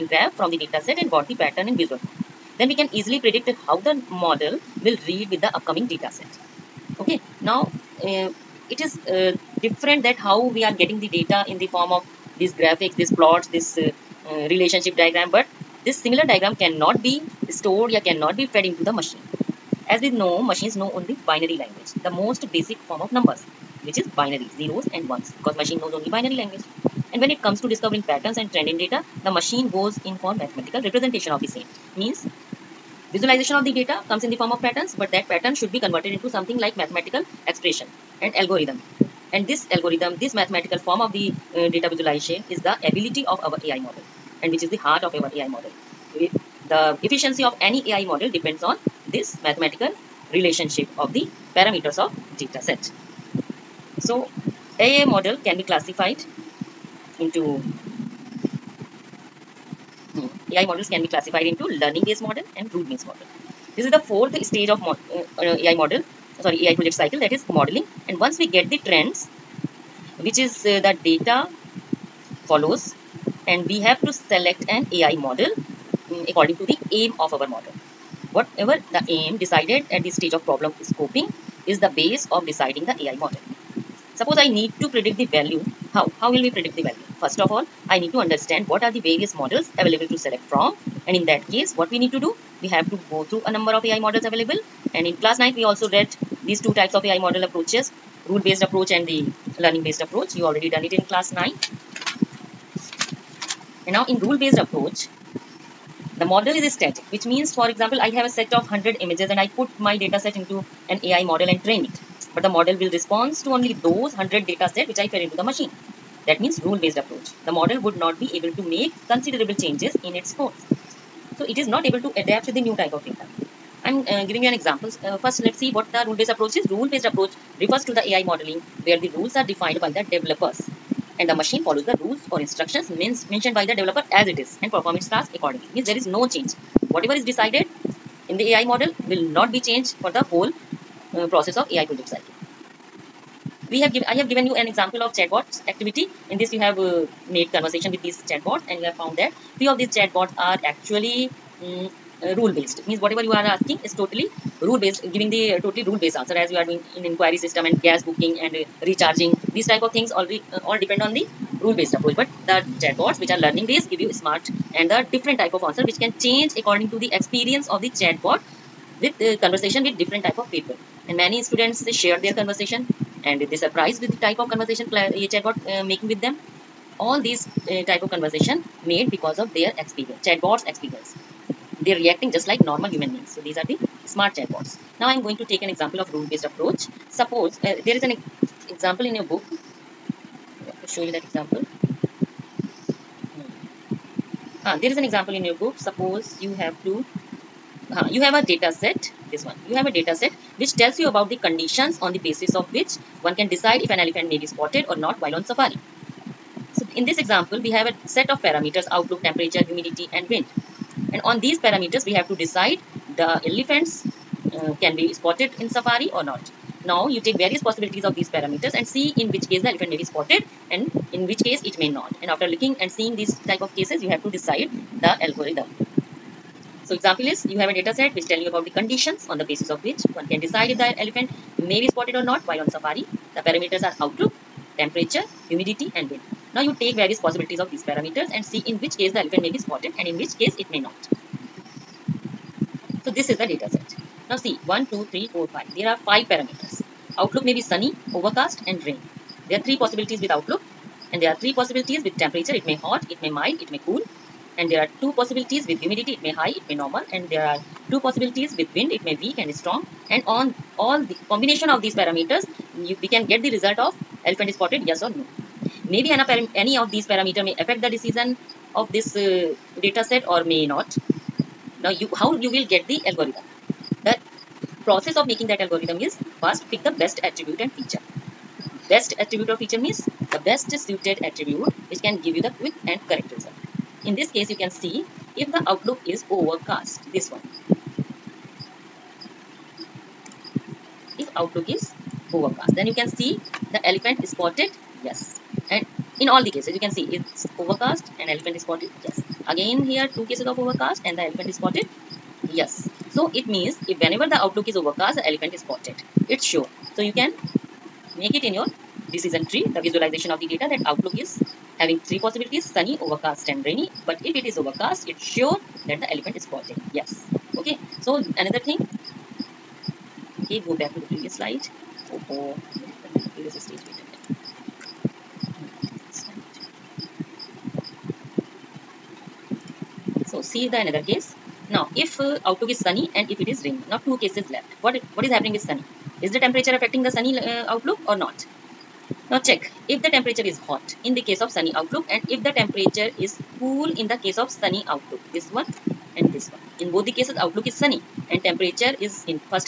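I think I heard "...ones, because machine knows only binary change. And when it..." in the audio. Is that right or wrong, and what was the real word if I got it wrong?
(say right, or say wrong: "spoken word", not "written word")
wrong: "language", not "change".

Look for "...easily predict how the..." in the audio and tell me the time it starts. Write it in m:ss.
0:02.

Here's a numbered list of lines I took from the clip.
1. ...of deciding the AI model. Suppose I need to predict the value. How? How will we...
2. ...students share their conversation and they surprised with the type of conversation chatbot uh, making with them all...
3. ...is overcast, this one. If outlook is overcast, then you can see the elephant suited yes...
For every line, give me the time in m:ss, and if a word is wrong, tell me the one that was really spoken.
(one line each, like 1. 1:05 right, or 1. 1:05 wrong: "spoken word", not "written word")
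1. 1:22 right
2. 2:51 right
3. 4:46 wrong: "spotted", not "suited".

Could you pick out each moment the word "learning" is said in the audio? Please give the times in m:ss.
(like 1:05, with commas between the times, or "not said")
1:01, 1:39, 2:43.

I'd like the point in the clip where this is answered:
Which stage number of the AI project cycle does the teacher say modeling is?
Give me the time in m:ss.
1:03.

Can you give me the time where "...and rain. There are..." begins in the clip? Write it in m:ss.
4:08.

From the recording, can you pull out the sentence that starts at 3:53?
The parameters are outlook, temperature, humidity and wind.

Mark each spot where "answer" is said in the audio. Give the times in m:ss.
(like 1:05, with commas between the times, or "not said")
2:36, 2:45.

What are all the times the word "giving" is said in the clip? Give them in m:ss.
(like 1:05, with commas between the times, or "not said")
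2:04, 2:35.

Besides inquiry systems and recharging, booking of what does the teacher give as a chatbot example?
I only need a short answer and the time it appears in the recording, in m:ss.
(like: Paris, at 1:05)
gas, at 2:37.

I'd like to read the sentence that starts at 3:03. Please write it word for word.
So these are the smart chatbots.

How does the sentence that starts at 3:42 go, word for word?
And after looking and seeing these type of cases, you have to decide the algorithm.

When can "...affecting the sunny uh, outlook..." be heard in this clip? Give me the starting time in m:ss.
5:36.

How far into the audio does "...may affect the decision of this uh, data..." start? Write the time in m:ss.
4:27.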